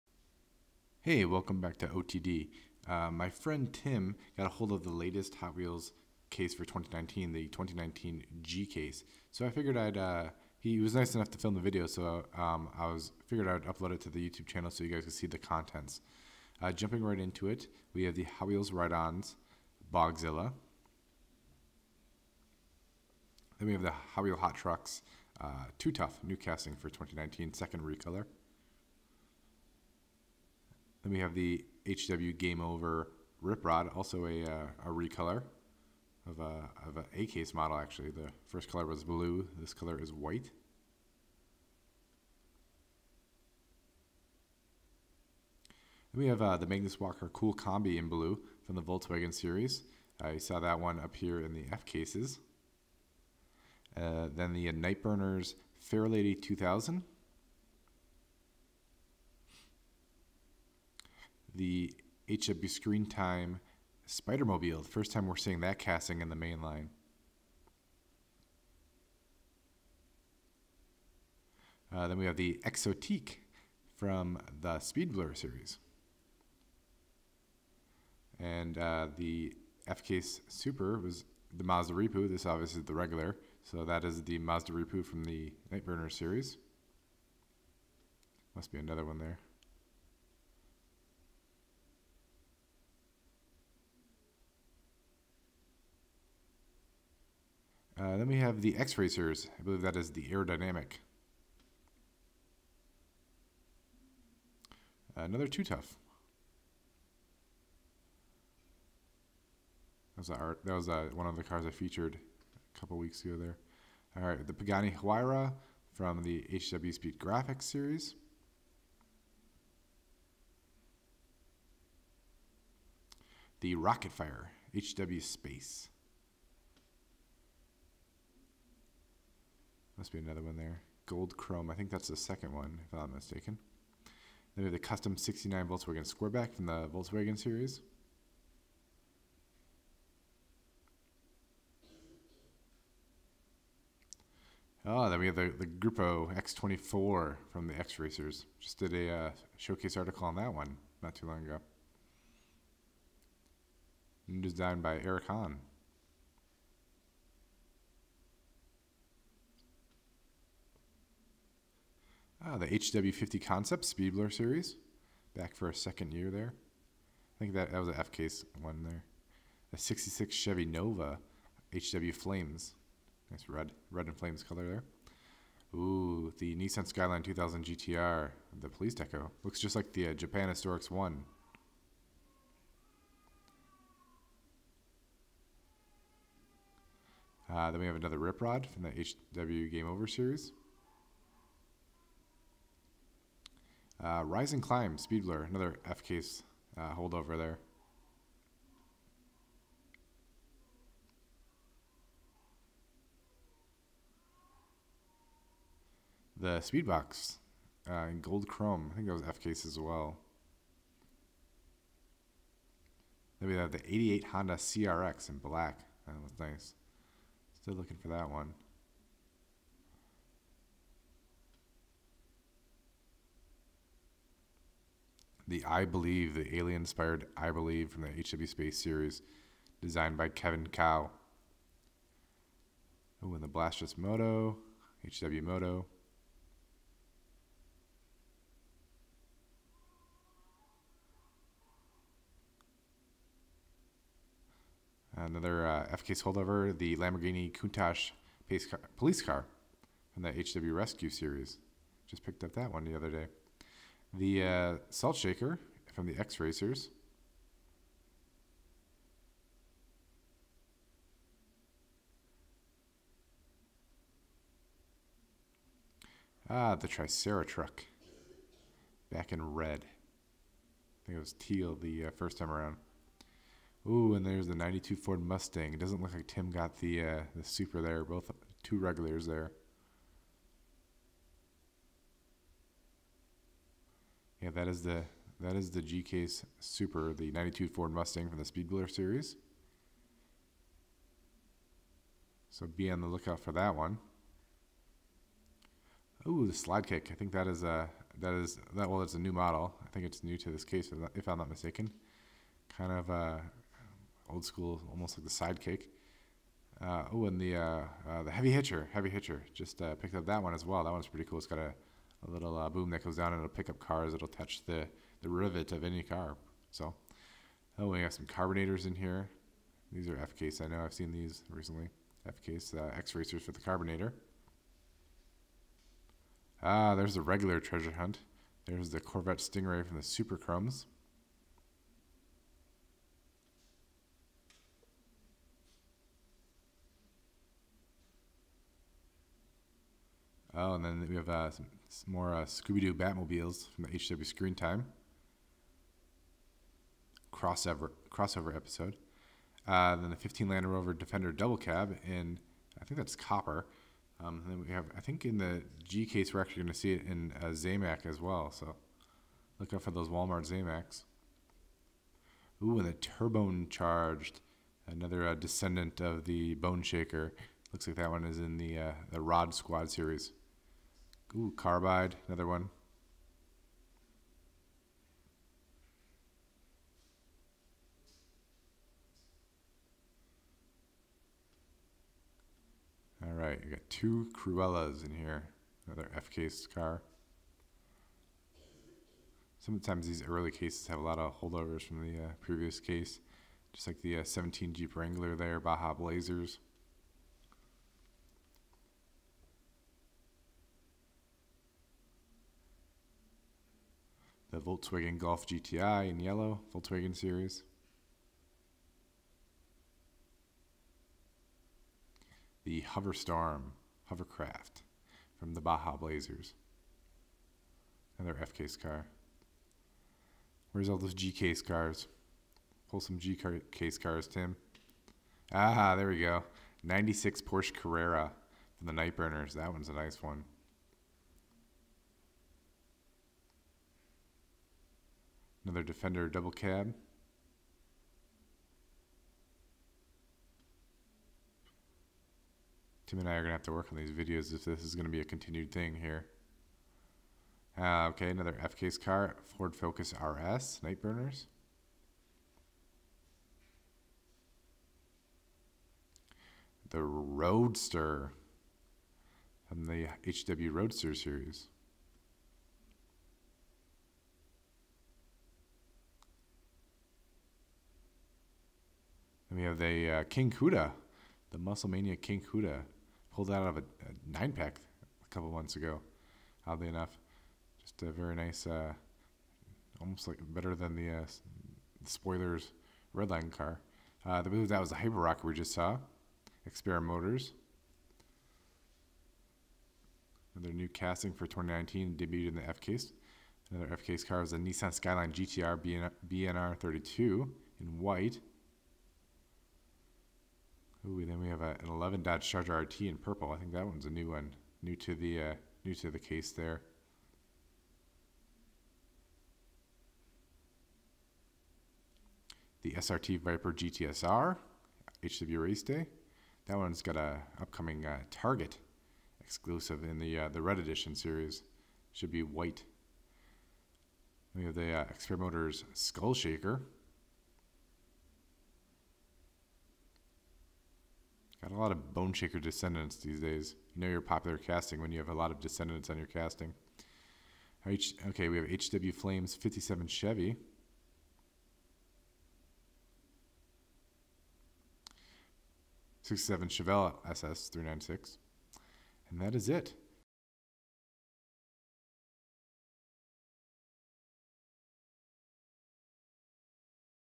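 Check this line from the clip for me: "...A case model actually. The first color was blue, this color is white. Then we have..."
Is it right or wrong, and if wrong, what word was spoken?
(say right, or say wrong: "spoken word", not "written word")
right.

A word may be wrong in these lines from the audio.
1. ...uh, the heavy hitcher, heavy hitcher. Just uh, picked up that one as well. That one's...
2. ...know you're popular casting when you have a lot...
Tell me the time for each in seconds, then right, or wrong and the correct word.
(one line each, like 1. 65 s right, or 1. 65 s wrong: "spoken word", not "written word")
1. 308 s right
2. 534 s right.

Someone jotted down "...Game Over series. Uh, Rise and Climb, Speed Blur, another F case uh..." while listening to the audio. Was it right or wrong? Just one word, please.
right.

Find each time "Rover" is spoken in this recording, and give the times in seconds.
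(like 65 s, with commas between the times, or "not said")
350 s.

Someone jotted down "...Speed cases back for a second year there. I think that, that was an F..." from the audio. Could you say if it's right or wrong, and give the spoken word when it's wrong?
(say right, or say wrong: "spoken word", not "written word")
wrong: "series", not "cases".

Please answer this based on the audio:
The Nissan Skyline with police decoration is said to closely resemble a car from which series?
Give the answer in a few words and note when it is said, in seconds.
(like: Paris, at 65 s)
Japan Historics 1, at 180 s.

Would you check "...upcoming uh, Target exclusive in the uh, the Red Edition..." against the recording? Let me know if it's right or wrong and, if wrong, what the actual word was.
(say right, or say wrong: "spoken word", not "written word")
right.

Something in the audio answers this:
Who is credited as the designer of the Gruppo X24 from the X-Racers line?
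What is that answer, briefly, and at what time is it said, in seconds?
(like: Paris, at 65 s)
Eric Hahn, at 155 s.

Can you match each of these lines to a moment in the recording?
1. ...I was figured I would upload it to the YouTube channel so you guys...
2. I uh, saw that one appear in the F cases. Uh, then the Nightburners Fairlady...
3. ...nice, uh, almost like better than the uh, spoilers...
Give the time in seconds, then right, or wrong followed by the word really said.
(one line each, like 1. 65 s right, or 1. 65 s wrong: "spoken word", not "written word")
1. 12 s right
2. 50 s right
3. 478 s right.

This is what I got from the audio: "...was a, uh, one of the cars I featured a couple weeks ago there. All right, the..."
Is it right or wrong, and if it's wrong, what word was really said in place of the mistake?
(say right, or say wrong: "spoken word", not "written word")
right.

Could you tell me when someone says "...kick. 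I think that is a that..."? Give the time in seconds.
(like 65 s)
296 s.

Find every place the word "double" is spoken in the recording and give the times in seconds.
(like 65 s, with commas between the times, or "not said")
351 s, 436 s.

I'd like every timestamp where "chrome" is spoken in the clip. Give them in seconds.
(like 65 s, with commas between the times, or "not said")
131 s, 208 s, 330 s.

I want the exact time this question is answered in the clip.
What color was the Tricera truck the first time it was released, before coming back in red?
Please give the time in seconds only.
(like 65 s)
271 s.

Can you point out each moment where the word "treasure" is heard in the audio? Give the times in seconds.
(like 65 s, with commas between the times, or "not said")
327 s.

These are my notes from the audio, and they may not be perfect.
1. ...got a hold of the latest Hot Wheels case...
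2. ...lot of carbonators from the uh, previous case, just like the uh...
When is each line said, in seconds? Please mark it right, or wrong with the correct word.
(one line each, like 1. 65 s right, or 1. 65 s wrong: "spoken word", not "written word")
1. 4 s right
2. 391 s wrong: "holdovers", not "carbonators".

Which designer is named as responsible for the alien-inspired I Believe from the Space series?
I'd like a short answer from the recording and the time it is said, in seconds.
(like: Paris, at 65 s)
Kevin Cao, at 230 s.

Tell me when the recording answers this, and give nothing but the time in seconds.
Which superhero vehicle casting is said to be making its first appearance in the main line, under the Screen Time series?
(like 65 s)
64 s.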